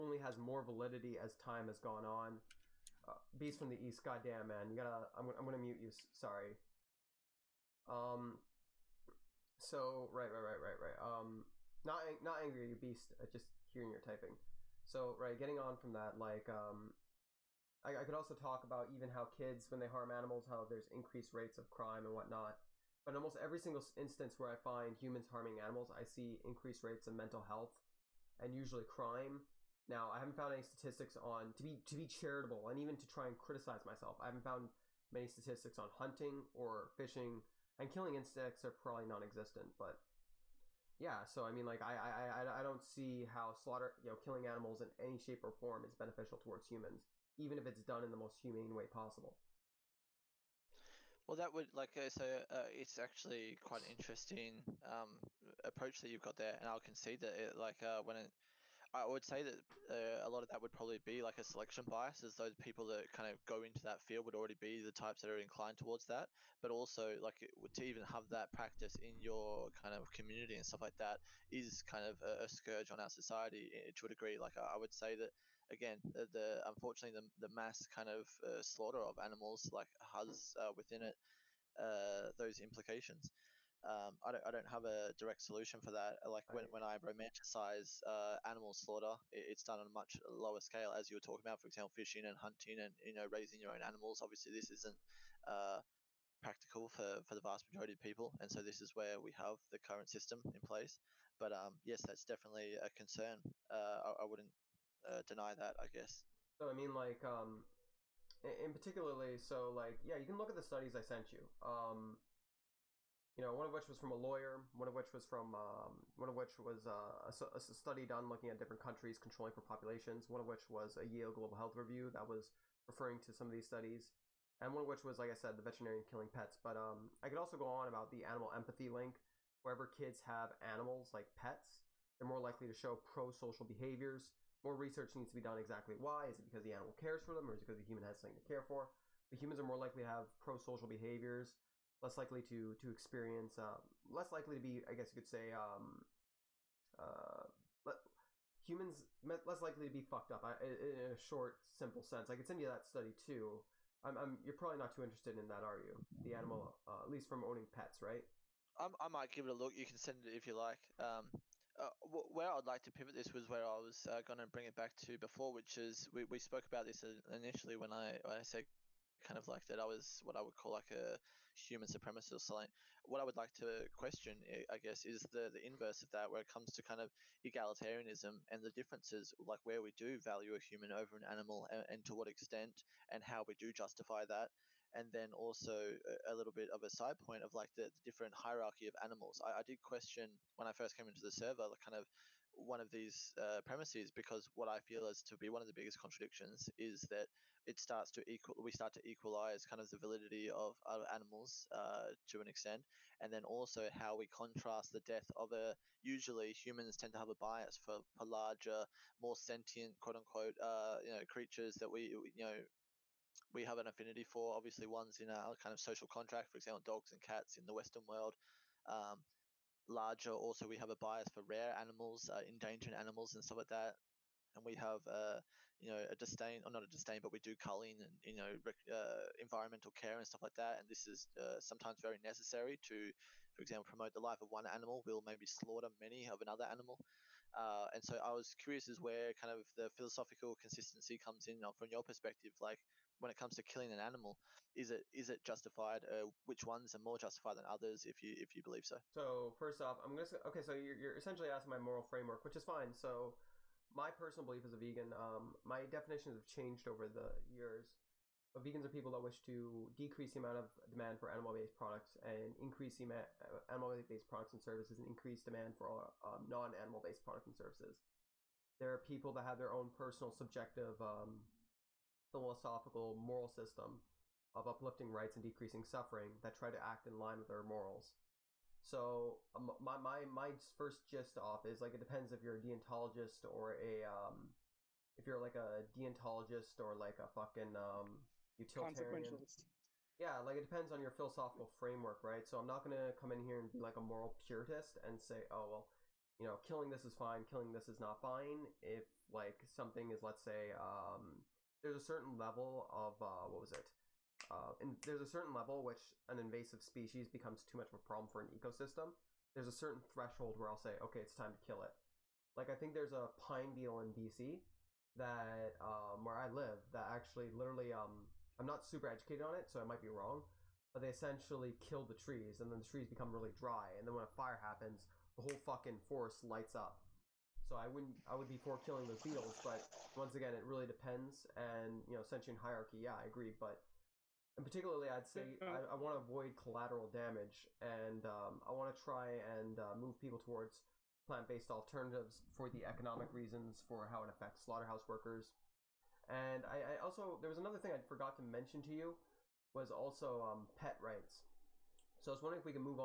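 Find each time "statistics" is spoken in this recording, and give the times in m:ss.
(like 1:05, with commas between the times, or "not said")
0:30, 0:35.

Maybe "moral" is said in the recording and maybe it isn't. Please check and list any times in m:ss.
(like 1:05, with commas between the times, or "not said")
4:11, 4:33, 4:37, 4:54.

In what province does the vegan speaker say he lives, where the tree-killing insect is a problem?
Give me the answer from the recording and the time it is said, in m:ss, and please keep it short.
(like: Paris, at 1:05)
BC, at 5:14.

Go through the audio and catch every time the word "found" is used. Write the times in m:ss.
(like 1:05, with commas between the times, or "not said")
0:30, 0:34.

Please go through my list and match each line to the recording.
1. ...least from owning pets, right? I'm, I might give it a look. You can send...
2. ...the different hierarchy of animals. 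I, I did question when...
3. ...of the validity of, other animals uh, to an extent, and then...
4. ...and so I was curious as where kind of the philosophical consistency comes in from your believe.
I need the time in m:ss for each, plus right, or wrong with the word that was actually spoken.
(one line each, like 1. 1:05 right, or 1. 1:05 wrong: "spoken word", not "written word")
1. 2:37 right
2. 3:07 right
3. 3:19 right
4. 3:57 wrong: "perspective", not "believe".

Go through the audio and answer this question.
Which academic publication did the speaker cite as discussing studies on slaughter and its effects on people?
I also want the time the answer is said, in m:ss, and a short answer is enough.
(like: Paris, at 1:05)
Yale Global Health Review, at 2:01.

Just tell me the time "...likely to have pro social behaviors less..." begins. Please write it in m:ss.
2:19.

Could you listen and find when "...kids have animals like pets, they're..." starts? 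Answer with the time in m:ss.
2:09.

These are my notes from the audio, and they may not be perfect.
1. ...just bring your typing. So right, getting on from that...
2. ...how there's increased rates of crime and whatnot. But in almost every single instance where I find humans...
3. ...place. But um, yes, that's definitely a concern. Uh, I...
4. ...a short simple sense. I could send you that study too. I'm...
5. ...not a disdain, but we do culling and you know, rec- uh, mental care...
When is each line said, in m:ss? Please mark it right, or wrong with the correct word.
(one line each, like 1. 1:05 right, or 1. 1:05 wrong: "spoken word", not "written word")
1. 0:13 wrong: "hearing", not "bring"
2. 0:20 right
3. 1:40 right
4. 2:31 right
5. 3:46 wrong: "environmental", not "mental".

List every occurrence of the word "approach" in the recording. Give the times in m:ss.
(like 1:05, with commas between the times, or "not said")
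0:55.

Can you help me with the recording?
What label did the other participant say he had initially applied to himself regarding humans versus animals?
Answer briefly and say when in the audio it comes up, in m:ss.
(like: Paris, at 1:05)
human supremacist, at 2:51.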